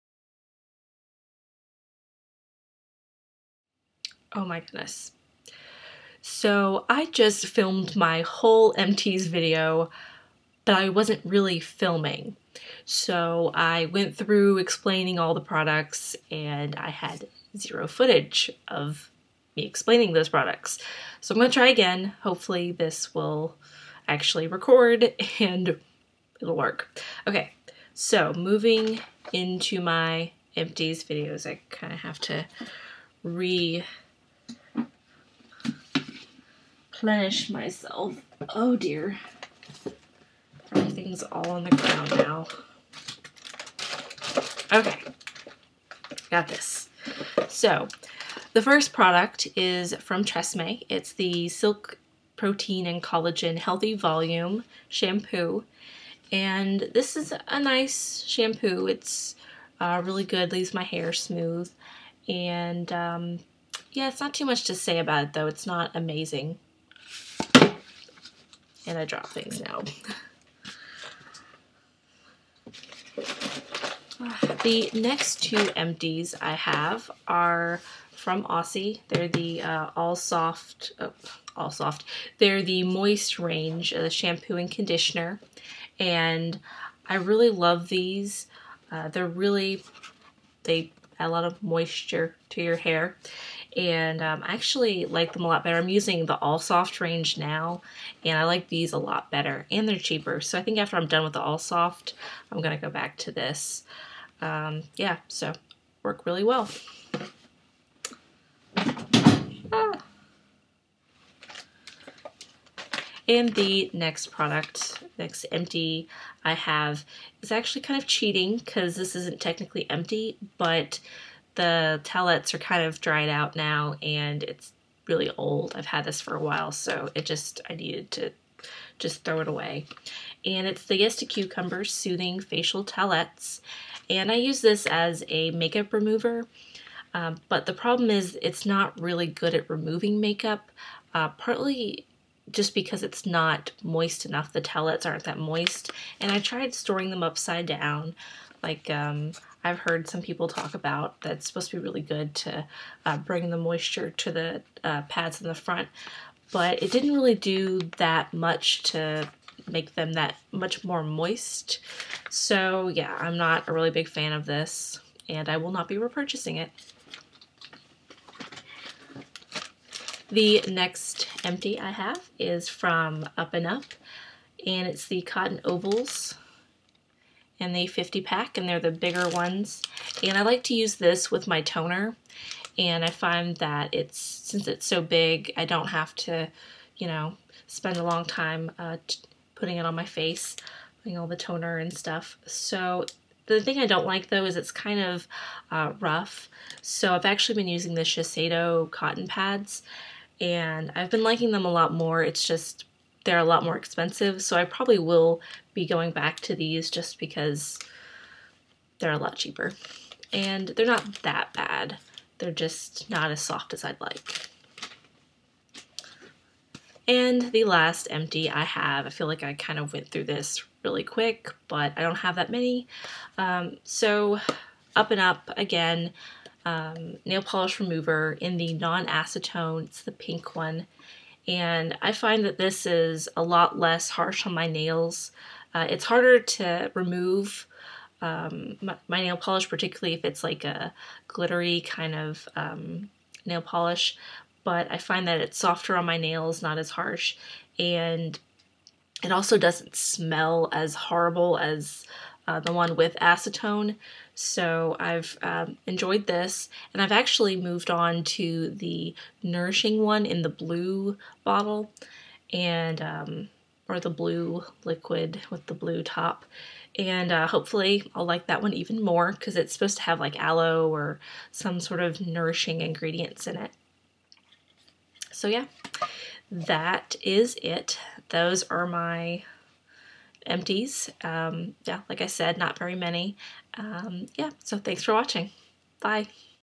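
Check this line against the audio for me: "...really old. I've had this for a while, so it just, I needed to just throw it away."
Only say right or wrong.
right.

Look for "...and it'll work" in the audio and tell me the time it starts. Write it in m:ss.
0:25.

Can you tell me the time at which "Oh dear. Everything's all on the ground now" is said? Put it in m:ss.
0:38.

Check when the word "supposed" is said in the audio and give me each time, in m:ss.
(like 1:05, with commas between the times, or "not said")
2:31, 4:29.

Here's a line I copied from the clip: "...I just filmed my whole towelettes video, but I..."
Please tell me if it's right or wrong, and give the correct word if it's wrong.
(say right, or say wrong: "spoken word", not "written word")
wrong: "empties", not "towelettes".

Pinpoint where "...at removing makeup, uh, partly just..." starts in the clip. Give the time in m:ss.
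2:19.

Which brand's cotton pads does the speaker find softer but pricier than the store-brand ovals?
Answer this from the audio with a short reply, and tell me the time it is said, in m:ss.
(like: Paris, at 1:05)
Shiseido, at 3:18.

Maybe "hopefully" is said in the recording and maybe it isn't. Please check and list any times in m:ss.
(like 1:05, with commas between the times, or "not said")
0:22, 4:27.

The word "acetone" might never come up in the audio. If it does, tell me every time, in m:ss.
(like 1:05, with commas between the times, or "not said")
3:48, 4:13.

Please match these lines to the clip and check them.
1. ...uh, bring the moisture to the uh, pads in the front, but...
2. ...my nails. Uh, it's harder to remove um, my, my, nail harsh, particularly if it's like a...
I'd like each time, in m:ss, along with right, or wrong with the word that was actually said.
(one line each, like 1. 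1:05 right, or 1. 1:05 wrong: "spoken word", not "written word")
1. 2:33 right
2. 3:54 wrong: "polish", not "harsh".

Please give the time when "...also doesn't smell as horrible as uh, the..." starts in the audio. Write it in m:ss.
4:09.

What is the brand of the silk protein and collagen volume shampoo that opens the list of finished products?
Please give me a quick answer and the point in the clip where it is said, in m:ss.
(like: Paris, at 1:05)
Tresemme, at 0:50.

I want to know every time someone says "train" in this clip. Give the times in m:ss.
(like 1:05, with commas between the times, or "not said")
not said.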